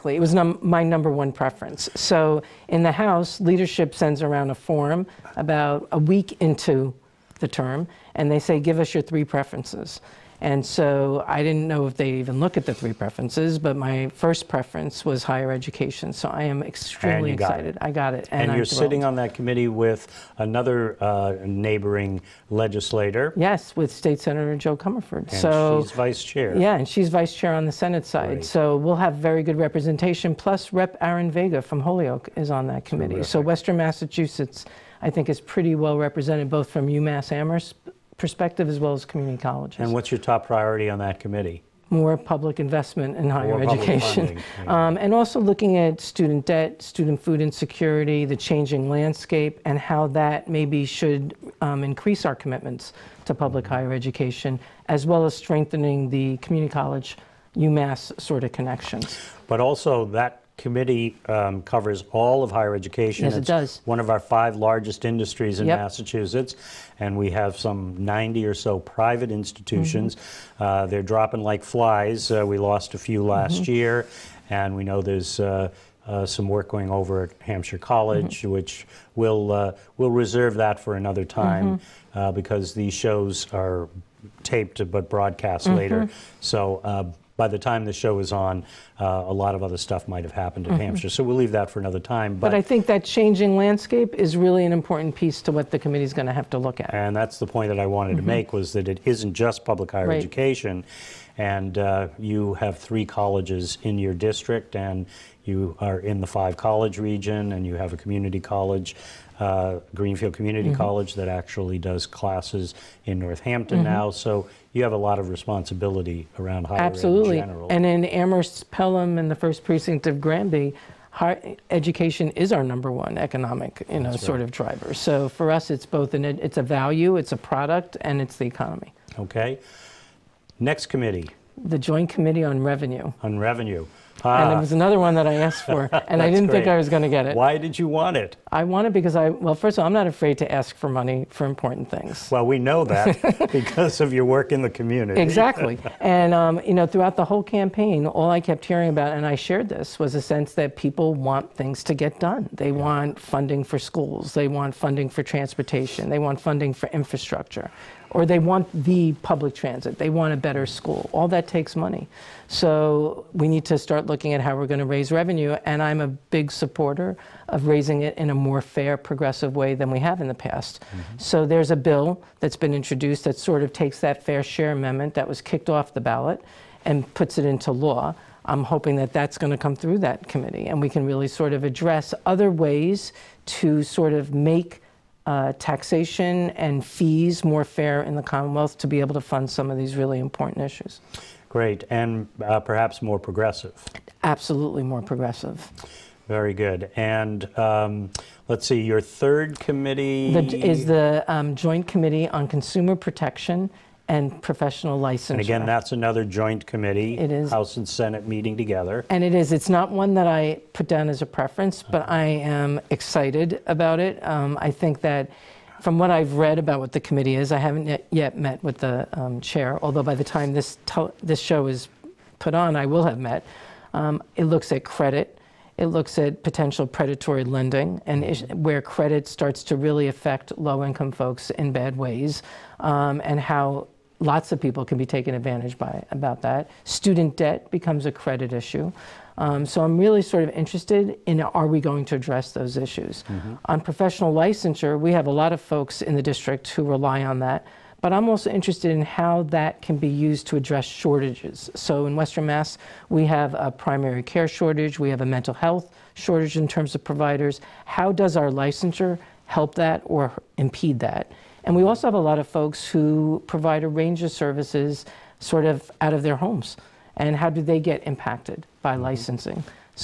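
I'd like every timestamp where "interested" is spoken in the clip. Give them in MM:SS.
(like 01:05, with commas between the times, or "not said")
04:00, 04:08.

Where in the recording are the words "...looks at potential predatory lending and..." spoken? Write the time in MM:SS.
03:45.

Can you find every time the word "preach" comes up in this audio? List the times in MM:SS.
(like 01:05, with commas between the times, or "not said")
not said.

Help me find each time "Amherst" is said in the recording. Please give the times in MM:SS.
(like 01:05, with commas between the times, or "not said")
00:37, 01:58.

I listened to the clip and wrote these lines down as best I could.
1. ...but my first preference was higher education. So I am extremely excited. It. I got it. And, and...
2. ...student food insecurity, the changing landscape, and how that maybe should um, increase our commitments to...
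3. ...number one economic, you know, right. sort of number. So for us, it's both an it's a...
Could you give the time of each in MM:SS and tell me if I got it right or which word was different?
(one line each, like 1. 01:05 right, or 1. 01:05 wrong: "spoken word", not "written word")
1. 00:13 right
2. 00:46 right
3. 02:02 wrong: "driver", not "number".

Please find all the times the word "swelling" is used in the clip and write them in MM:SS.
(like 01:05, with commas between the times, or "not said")
not said.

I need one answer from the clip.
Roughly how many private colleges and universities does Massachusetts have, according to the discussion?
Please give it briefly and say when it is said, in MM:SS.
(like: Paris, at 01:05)
90, at 01:08.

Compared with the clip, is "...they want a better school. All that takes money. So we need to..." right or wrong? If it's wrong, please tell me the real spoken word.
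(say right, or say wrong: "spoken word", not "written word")
right.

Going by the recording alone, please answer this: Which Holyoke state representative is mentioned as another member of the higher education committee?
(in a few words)
Aaron Vega.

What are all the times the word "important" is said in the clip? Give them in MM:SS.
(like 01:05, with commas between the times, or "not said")
01:34, 02:21, 03:10.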